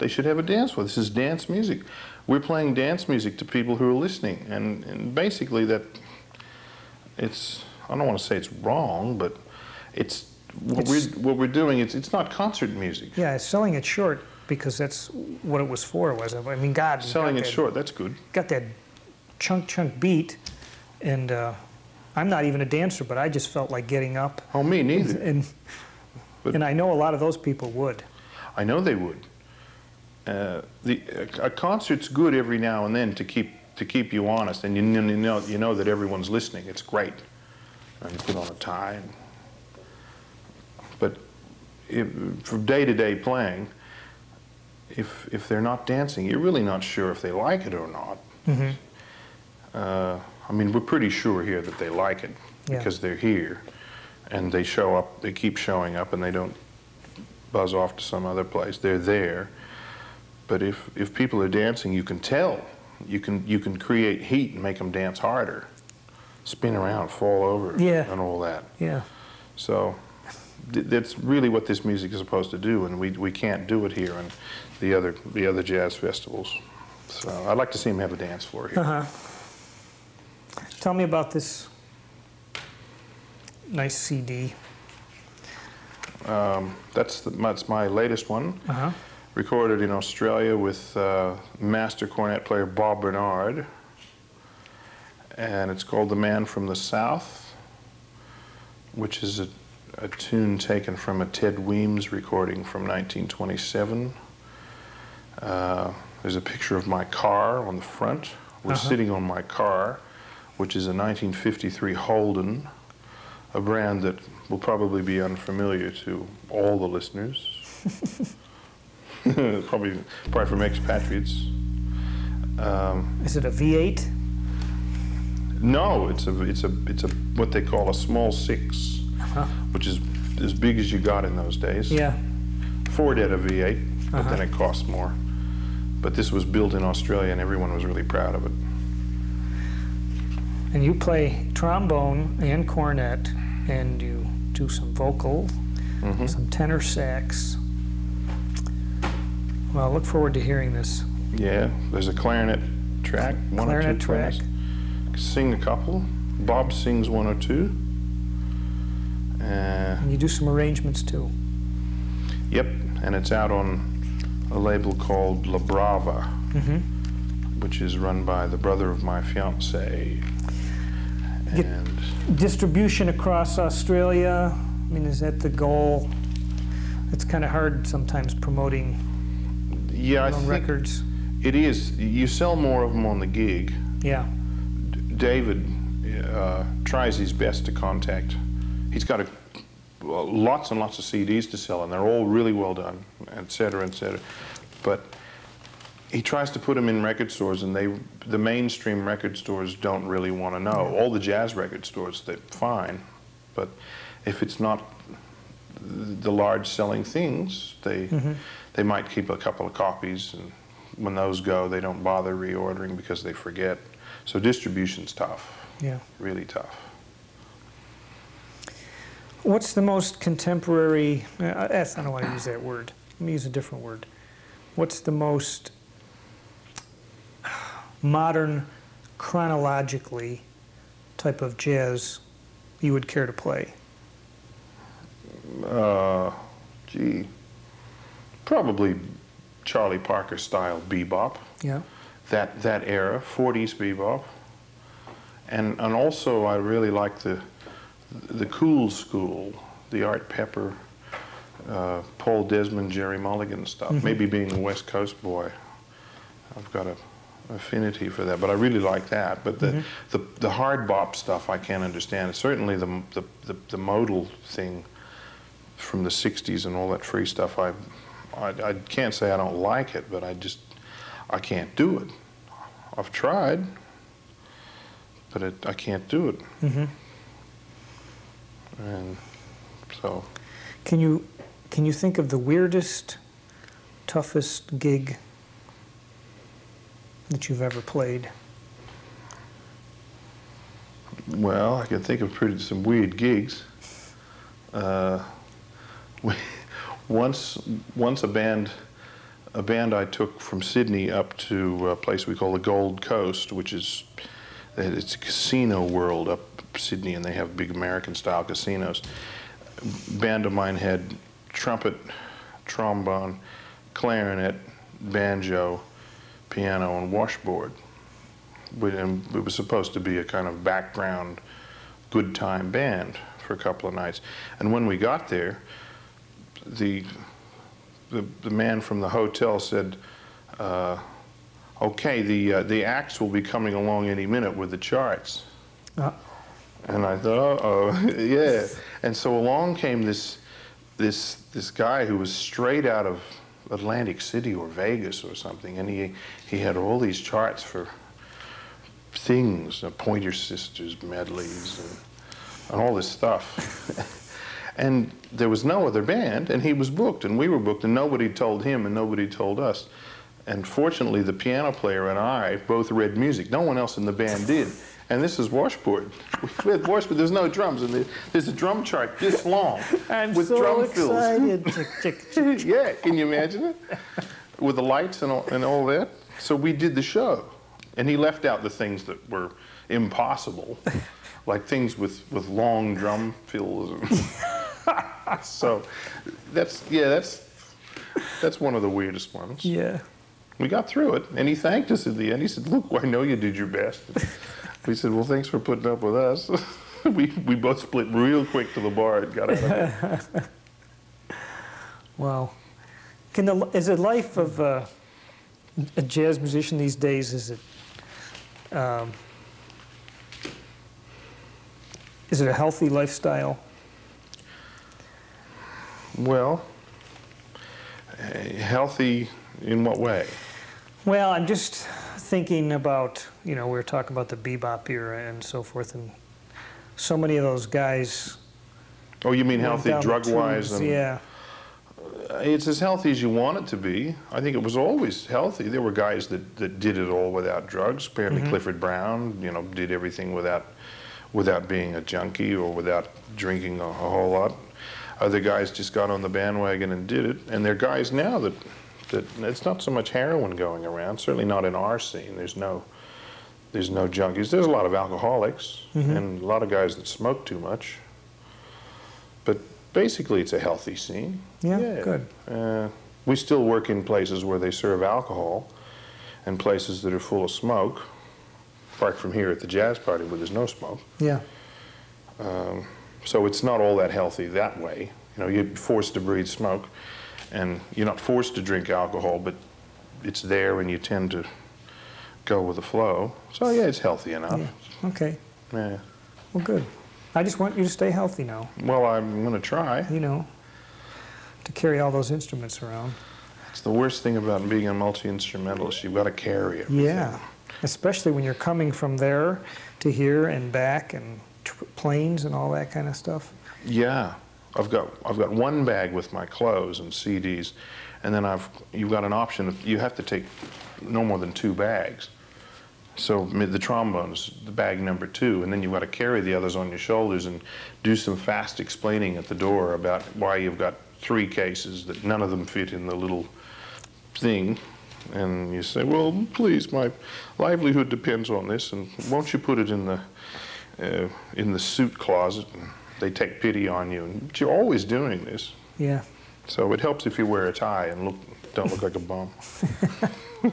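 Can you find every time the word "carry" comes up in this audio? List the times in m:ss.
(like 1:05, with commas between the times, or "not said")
8:11, 8:16, 8:36.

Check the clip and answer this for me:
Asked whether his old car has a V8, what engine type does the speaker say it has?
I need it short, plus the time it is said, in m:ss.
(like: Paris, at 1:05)
Small 6, at 2:07.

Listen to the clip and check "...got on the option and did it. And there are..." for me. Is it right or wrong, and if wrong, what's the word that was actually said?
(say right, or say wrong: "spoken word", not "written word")
wrong: "bandwagon", not "option".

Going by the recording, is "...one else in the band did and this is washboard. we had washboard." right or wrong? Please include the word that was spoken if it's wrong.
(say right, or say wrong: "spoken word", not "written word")
right.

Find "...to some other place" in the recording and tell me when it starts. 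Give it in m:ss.
0:57.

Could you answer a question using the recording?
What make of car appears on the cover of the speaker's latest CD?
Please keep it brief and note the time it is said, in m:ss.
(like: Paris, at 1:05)
Holden, at 1:51.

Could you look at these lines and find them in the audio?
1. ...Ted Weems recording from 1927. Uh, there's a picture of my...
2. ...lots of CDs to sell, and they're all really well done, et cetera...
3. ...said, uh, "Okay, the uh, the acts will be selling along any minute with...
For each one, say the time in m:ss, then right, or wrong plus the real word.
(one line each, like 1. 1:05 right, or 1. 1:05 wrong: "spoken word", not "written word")
1. 1:41 right
2. 3:10 right
3. 5:29 wrong: "coming", not "selling".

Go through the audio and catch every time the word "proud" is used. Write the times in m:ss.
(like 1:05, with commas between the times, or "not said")
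2:18.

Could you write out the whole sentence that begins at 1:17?
So I'd like to see them have a dance floor here.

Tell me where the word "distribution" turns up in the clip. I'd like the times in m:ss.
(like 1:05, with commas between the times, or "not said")
2:52, 3:34.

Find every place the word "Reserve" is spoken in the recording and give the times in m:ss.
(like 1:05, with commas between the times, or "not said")
not said.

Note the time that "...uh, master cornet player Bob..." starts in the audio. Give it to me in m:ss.
1:30.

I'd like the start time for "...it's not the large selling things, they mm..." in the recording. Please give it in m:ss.
3:24.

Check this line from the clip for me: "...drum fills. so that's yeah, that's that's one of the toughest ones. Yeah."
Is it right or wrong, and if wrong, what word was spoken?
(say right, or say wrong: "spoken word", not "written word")
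wrong: "weirdest", not "toughest".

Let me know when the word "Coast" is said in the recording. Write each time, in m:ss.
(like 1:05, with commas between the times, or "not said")
4:14, 5:03.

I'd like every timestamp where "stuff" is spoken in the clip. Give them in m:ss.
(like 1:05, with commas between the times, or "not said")
4:13, 4:21, 4:27, 5:53, 8:23.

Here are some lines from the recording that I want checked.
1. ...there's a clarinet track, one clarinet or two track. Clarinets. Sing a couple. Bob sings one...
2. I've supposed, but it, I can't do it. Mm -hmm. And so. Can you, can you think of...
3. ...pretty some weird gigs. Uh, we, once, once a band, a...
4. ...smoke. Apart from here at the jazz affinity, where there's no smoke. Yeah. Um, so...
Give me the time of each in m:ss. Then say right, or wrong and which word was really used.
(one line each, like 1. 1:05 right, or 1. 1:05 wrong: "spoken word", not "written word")
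1. 2:31 right
2. 4:32 wrong: "tried", not "supposed"
3. 4:52 right
4. 7:47 wrong: "party", not "affinity".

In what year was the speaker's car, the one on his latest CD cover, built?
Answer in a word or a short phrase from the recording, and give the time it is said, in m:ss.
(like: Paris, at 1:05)
1953, at 1:50.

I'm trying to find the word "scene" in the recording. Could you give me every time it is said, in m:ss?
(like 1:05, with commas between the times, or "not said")
7:31, 7:40.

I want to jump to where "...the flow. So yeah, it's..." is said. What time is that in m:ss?
8:02.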